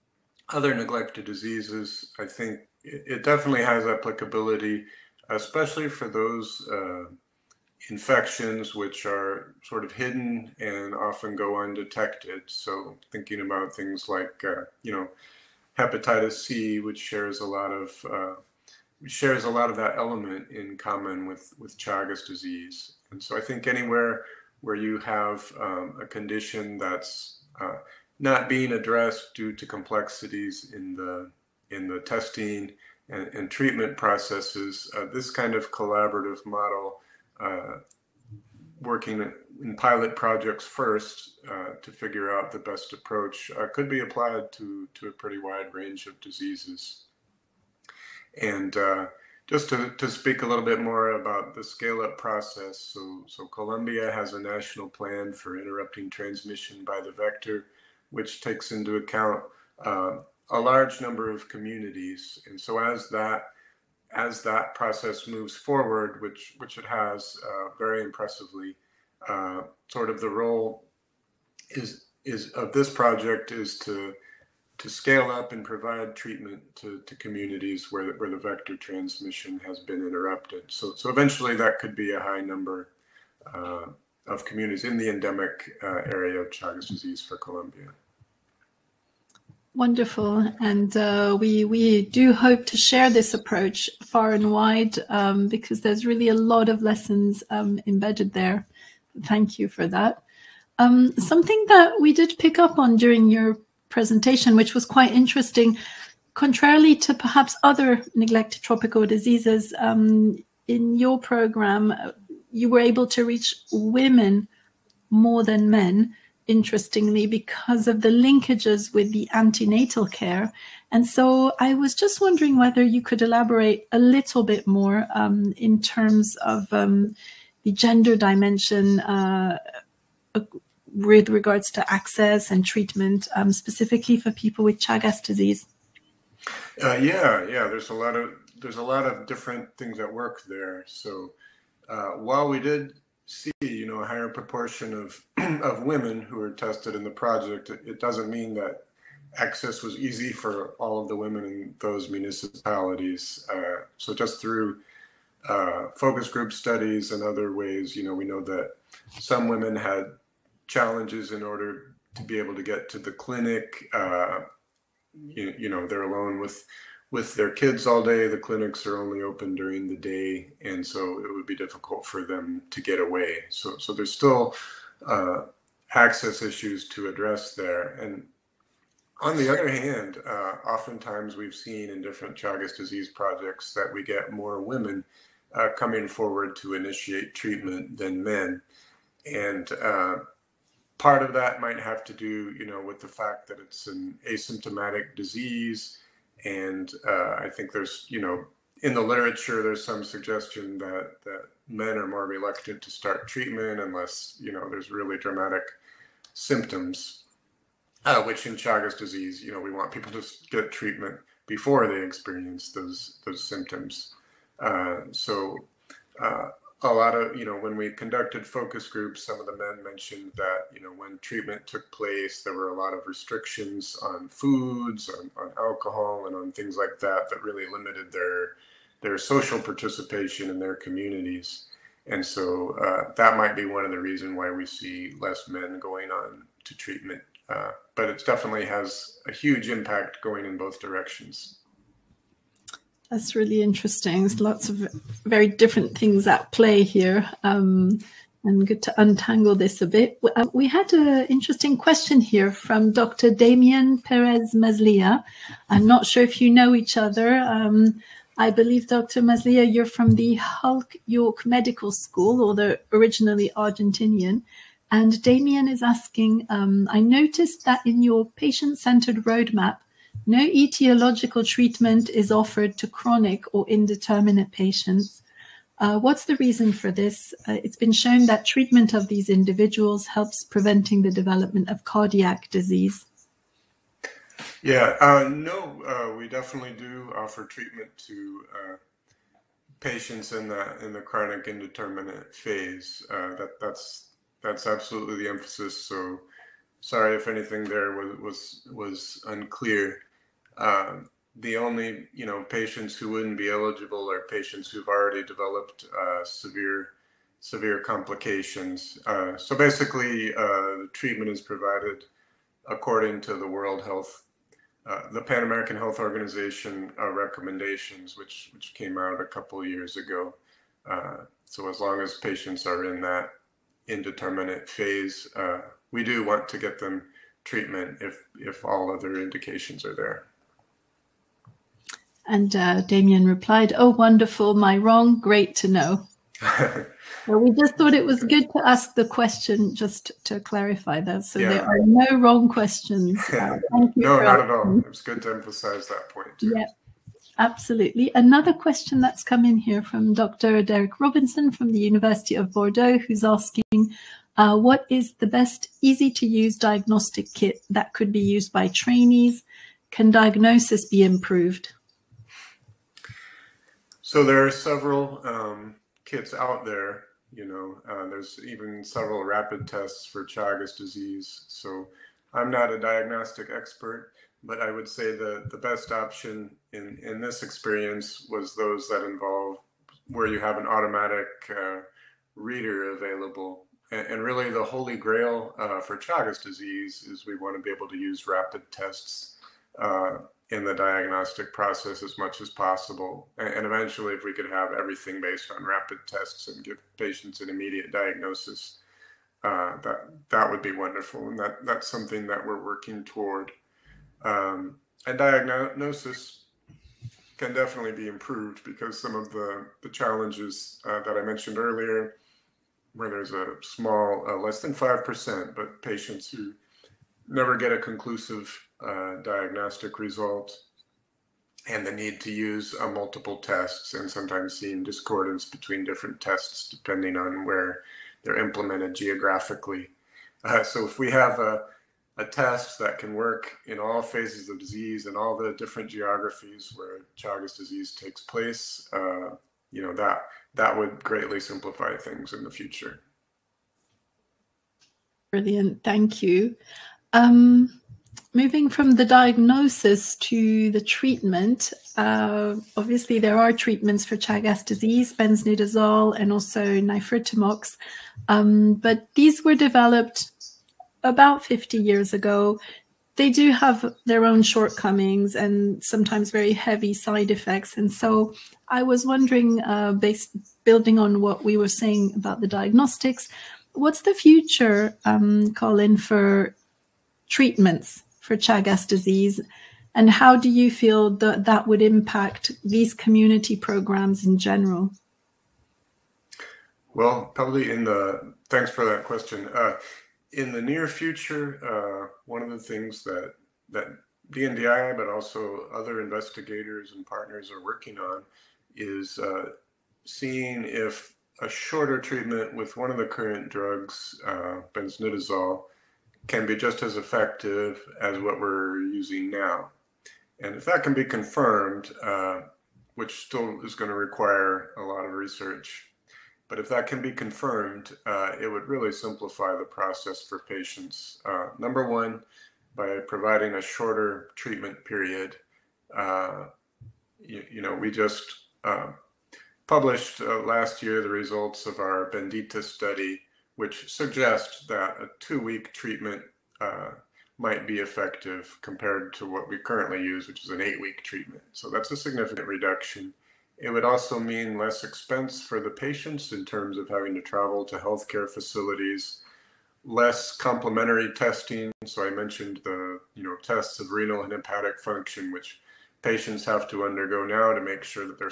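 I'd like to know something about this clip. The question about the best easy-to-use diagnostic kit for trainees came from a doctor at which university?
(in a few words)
University of Bordeaux.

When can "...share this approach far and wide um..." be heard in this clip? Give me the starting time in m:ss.
1:32.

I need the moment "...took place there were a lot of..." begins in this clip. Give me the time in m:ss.
3:41.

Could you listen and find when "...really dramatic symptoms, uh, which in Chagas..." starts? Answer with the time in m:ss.
3:24.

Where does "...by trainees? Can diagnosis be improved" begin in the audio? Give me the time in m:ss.
5:58.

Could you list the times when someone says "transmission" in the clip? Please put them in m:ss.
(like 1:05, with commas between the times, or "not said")
0:56, 1:18.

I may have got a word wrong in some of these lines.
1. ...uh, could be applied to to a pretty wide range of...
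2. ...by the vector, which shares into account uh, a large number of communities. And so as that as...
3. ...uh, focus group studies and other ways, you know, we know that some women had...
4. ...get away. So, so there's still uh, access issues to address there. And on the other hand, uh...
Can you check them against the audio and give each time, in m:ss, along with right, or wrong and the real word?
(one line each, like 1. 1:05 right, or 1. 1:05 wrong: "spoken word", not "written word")
1. 0:43 right
2. 0:56 wrong: "takes", not "shares"
3. 2:35 right
4. 2:52 right.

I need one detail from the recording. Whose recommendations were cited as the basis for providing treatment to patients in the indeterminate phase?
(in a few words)
Pan American Health Organization.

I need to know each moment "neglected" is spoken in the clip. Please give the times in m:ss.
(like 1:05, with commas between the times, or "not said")
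0:00, 1:48.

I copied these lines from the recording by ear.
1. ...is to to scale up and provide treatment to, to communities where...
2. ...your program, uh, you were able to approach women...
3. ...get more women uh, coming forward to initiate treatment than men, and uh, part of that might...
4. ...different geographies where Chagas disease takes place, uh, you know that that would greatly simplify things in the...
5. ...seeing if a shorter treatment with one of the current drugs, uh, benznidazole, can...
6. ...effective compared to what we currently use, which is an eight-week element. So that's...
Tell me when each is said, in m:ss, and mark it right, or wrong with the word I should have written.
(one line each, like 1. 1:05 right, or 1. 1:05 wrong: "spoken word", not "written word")
1. 1:13 right
2. 1:50 wrong: "reach", not "approach"
3. 3:04 right
4. 7:15 right
5. 8:20 right
6. 8:57 wrong: "treatment", not "element".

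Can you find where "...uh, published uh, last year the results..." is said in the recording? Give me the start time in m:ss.
8:48.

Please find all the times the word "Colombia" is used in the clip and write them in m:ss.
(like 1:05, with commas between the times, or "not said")
0:53, 1:27.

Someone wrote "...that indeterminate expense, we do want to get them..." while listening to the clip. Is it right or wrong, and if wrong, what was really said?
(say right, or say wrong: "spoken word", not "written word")
wrong: "phase", not "expense".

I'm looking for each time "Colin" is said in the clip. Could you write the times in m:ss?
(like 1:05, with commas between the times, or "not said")
7:55.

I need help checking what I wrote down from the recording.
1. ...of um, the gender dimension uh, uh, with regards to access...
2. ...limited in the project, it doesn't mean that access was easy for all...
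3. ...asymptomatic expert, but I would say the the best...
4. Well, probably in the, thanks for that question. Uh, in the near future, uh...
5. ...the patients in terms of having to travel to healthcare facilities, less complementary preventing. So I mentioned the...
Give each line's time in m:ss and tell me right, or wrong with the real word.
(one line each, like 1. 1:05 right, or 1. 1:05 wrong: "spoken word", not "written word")
1. 2:06 right
2. 2:26 wrong: "tested", not "limited"
3. 6:12 wrong: "diagnostic", not "asymptomatic"
4. 8:06 right
5. 9:05 wrong: "testing", not "preventing".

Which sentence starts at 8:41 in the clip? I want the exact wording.
Uh, number one, by providing a shorter treatment period.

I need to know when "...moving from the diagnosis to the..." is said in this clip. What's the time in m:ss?
7:28.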